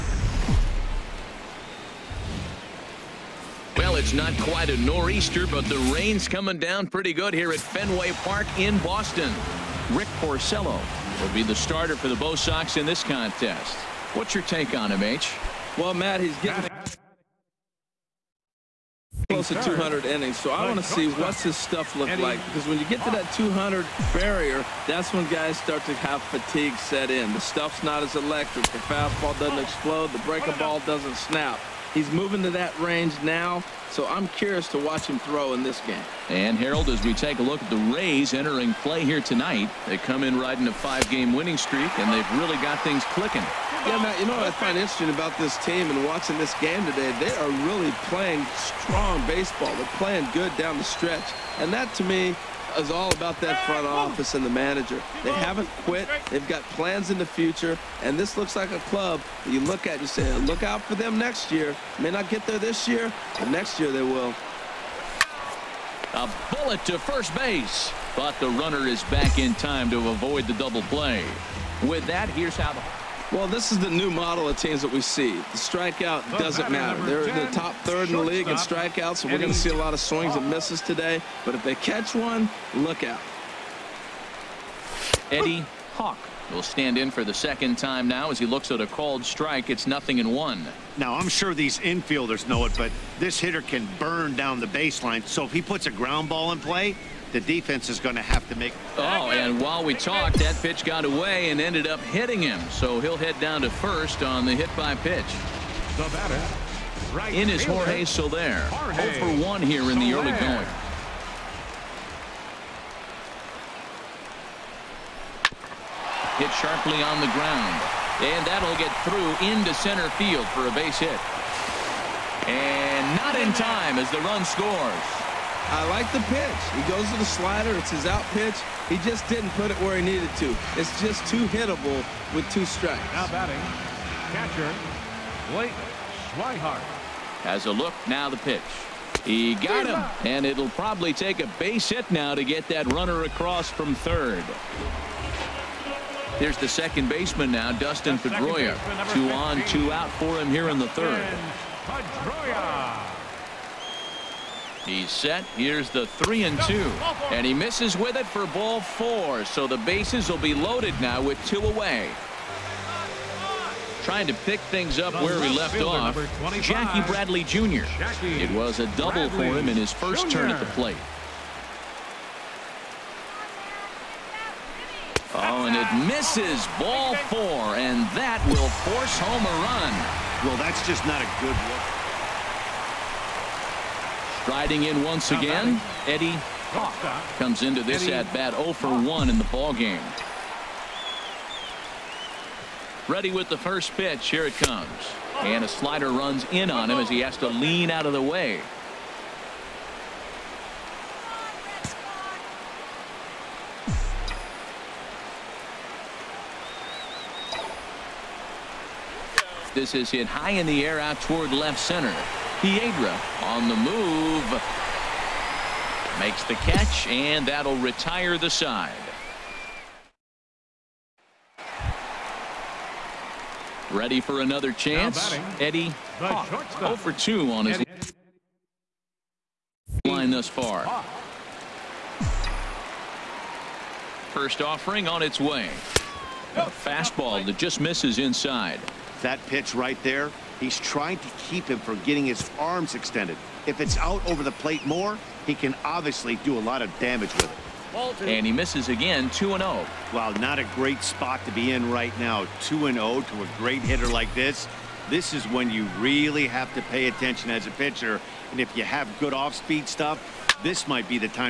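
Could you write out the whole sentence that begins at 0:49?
They're playing good down the stretch, and that, to me, is all about that front office and the manager.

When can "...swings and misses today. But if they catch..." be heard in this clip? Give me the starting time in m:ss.
1:20.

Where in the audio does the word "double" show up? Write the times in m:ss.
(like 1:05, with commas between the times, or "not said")
1:10, 2:48.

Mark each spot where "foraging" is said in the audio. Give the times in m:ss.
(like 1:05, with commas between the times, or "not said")
not said.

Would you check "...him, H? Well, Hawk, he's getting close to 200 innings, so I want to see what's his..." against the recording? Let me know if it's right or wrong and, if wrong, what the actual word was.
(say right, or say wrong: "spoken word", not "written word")
wrong: "Matt", not "Hawk".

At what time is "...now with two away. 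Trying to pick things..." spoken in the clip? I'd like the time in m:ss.
2:41.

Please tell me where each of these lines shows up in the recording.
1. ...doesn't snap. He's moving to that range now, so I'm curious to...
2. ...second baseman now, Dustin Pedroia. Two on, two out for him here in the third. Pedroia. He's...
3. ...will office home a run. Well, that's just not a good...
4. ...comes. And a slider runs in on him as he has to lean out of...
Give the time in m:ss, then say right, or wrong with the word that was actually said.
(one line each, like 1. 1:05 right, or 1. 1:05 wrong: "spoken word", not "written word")
1. 0:30 right
2. 2:26 right
3. 2:58 wrong: "force", not "office"
4. 3:14 right.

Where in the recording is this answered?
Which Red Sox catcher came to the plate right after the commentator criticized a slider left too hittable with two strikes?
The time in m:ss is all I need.
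2:15.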